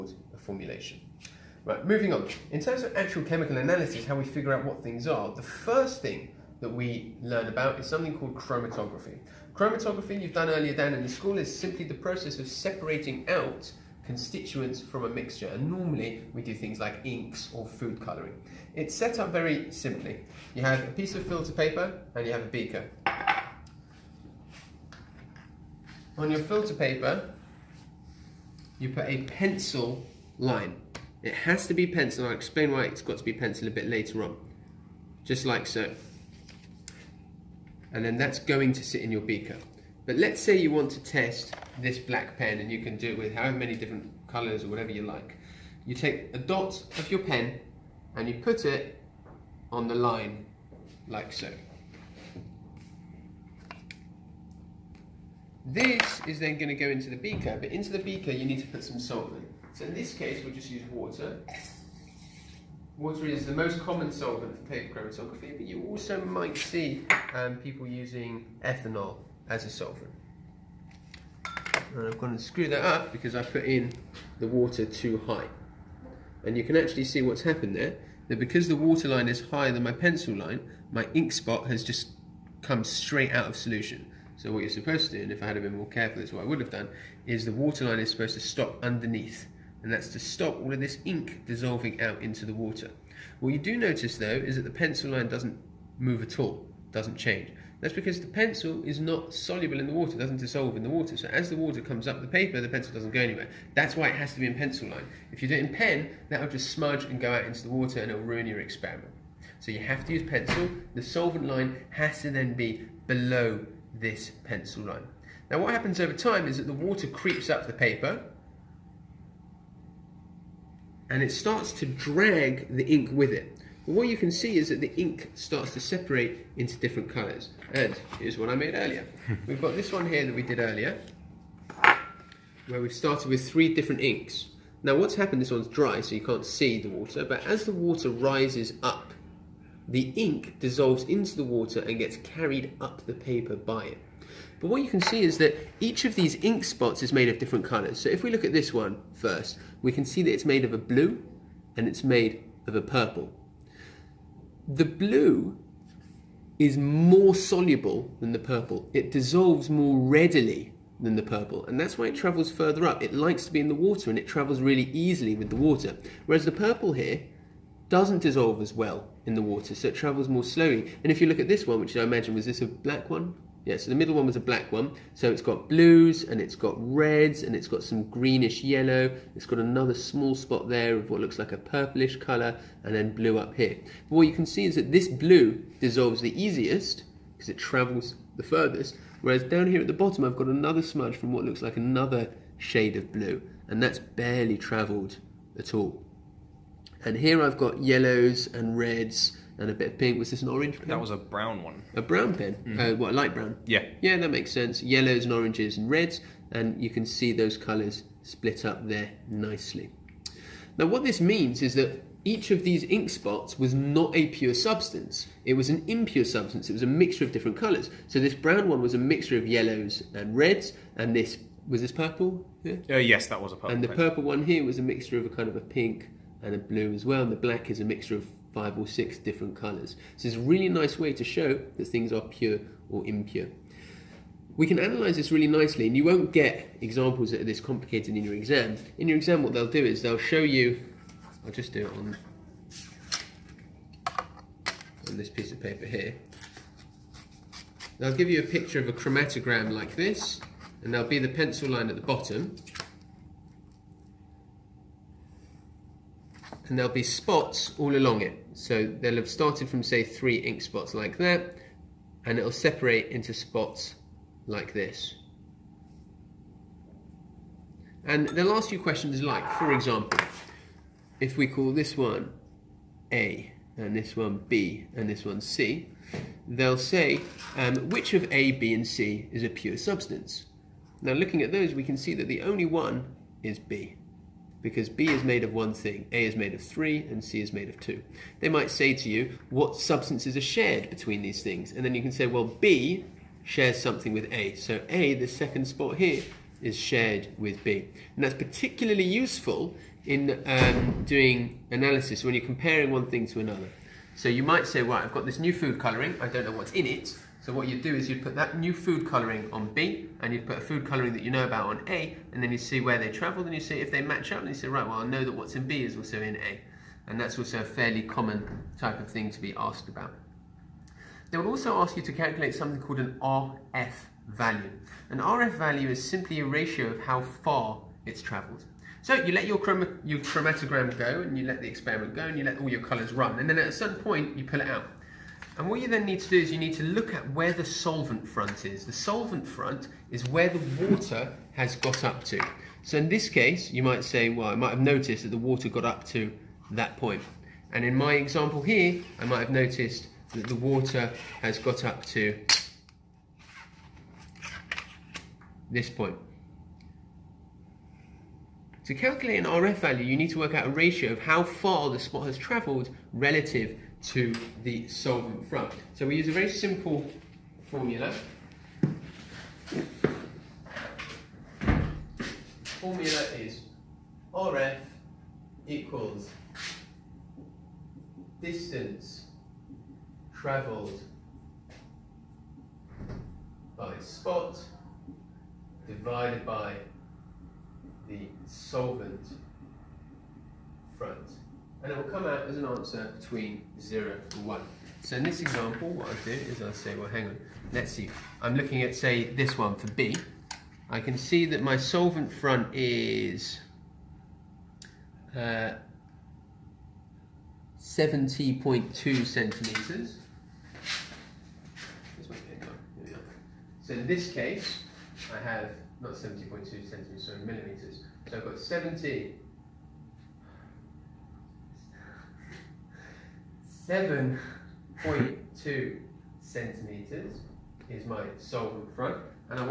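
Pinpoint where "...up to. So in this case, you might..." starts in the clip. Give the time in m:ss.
5:42.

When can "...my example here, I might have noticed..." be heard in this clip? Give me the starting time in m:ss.
5:47.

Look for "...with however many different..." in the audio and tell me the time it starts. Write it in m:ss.
0:43.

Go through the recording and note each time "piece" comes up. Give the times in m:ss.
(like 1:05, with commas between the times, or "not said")
0:20, 4:05.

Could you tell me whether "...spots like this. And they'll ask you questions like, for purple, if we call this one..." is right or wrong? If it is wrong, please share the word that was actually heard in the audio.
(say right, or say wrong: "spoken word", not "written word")
wrong: "example", not "purple".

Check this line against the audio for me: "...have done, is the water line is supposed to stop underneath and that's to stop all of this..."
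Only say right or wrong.
right.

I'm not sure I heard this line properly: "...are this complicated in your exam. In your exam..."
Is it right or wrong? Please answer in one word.
right.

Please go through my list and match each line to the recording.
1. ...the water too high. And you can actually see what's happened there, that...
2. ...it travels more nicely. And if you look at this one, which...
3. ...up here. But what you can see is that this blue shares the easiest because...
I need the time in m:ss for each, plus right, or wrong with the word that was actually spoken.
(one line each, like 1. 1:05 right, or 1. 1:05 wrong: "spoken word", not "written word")
1. 1:14 right
2. 2:49 wrong: "slowly", not "nicely"
3. 3:03 wrong: "dissolves", not "shares".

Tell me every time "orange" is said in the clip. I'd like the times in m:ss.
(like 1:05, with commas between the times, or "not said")
3:20, 3:25.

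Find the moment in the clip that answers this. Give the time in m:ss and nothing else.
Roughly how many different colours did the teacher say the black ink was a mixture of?
3:48.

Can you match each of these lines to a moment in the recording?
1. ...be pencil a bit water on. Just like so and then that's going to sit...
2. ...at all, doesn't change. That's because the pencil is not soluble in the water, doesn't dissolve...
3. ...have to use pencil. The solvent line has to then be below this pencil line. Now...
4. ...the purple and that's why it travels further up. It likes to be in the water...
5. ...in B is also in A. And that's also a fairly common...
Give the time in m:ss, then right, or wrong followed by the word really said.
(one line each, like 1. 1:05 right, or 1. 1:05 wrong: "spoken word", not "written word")
1. 0:33 wrong: "later", not "water"
2. 1:36 right
3. 1:49 right
4. 2:41 right
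5. 5:15 right.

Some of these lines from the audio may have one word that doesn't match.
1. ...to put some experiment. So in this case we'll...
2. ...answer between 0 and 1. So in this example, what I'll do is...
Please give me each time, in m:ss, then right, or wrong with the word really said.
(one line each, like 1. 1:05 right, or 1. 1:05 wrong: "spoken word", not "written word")
1. 0:58 wrong: "solvent", not "experiment"
2. 6:32 right.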